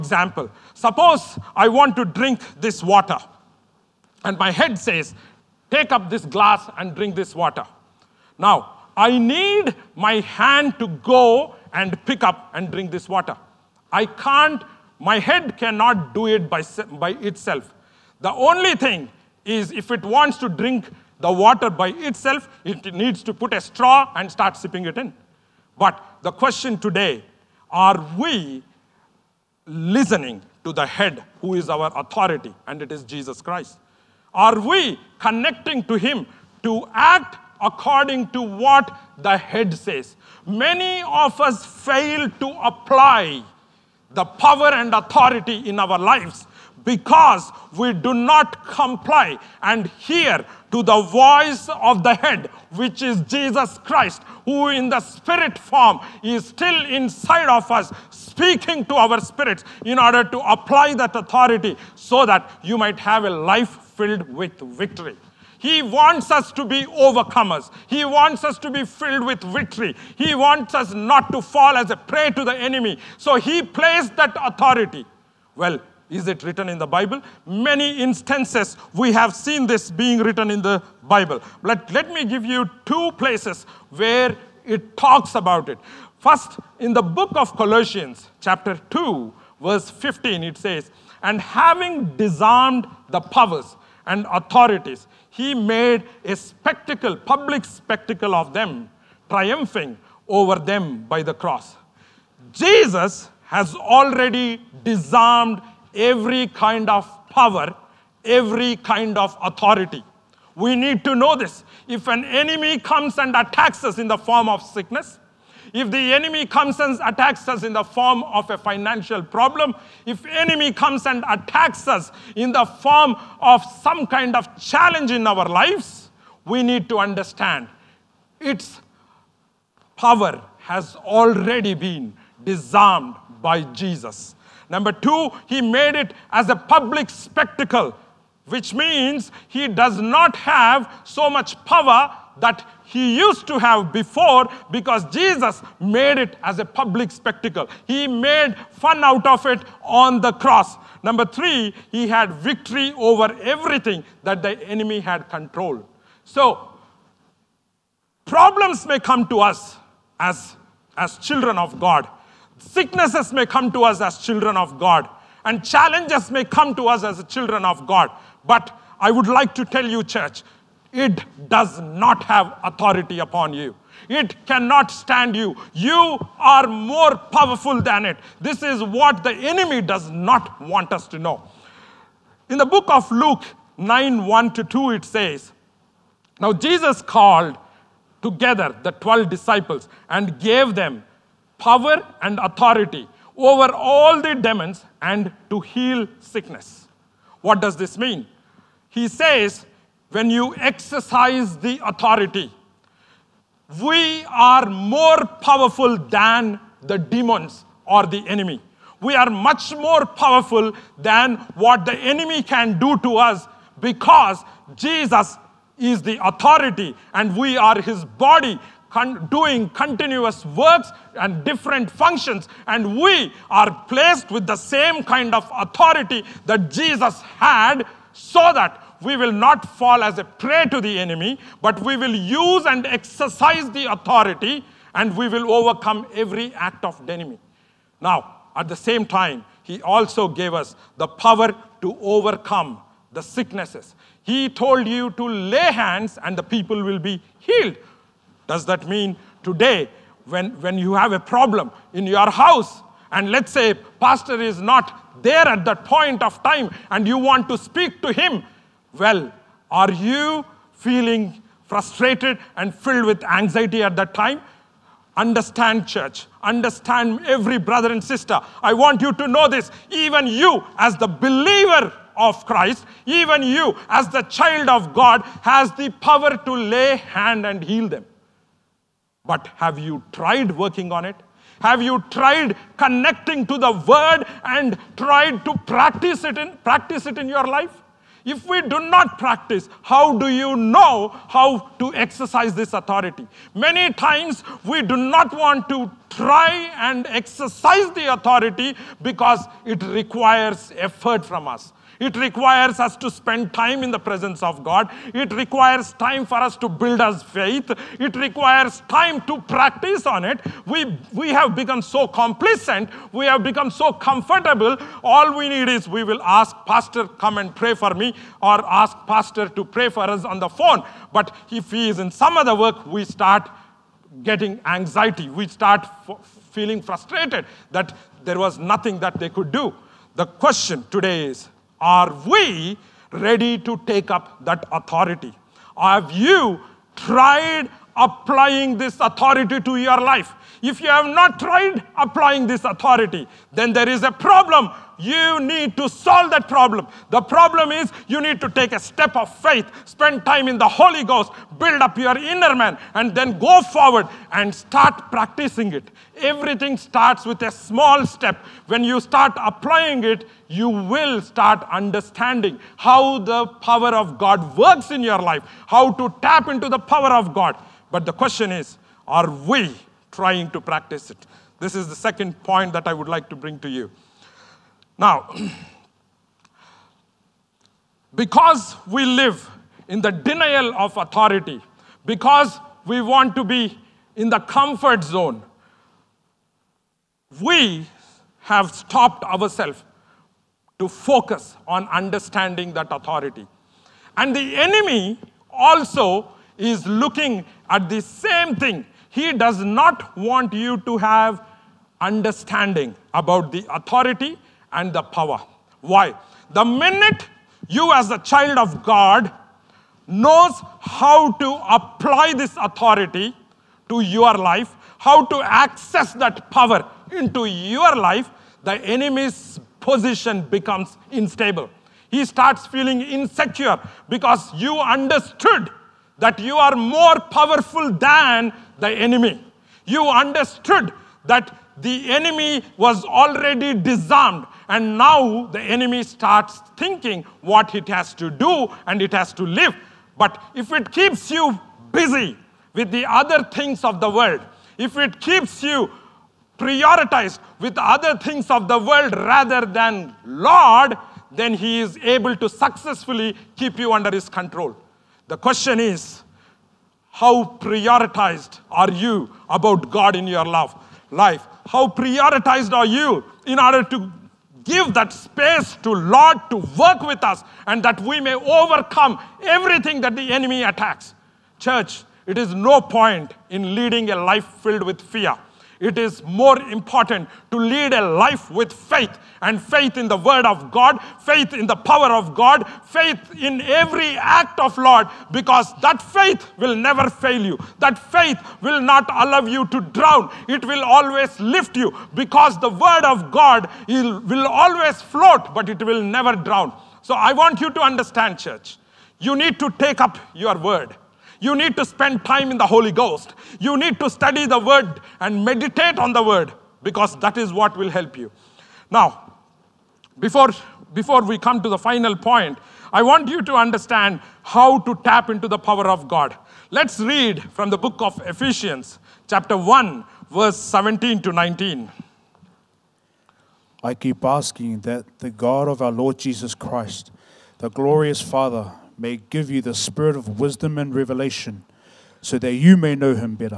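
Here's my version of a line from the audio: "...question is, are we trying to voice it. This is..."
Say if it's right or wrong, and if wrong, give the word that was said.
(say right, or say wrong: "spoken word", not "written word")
wrong: "practice", not "voice".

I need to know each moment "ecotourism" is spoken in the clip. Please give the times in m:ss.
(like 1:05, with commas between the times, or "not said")
not said.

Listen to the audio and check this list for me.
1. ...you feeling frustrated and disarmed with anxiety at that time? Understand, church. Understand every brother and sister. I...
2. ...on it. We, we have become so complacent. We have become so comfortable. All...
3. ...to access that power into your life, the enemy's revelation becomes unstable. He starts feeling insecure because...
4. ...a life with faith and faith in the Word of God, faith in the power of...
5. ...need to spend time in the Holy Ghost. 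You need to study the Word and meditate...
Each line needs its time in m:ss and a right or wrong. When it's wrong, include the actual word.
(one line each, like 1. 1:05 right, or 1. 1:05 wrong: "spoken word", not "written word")
1. 4:19 wrong: "filled", not "disarmed"
2. 5:10 right
3. 6:55 wrong: "position", not "revelation"
4. 7:57 right
5. 8:21 right.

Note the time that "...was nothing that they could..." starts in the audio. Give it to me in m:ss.
5:28.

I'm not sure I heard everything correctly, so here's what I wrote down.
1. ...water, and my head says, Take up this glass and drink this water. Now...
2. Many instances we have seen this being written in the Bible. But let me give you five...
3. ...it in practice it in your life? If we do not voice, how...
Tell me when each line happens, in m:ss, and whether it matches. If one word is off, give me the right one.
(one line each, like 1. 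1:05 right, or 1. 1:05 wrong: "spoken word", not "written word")
1. 0:02 right
2. 1:17 wrong: "two", not "five"
3. 4:46 wrong: "practice", not "voice".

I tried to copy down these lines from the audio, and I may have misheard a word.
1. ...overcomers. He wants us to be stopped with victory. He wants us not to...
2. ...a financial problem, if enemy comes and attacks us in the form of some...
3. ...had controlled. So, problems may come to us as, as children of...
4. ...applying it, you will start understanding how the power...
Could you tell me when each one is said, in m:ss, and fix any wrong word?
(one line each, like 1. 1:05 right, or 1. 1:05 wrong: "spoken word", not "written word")
1. 1:06 wrong: "filled", not "stopped"
2. 1:58 right
3. 2:34 right
4. 5:59 right.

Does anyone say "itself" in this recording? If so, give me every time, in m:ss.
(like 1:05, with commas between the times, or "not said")
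0:17, 0:21.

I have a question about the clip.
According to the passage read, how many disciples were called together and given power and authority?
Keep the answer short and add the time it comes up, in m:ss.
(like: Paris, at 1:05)
12, at 3:08.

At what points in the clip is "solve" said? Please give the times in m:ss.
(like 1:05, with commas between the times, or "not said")
5:45.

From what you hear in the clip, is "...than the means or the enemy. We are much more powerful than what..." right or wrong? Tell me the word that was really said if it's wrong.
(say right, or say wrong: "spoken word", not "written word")
wrong: "demons", not "means".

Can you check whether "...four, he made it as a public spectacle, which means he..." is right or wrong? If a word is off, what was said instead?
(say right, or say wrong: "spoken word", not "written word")
wrong: "two", not "four".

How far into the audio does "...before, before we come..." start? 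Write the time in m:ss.
8:30.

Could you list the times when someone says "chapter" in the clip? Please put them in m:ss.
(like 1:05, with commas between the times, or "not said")
1:28, 8:39.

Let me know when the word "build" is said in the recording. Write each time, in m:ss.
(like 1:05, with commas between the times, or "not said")
5:06, 5:51.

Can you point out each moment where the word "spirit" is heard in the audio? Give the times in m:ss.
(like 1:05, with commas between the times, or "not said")
0:54, 0:59, 8:49.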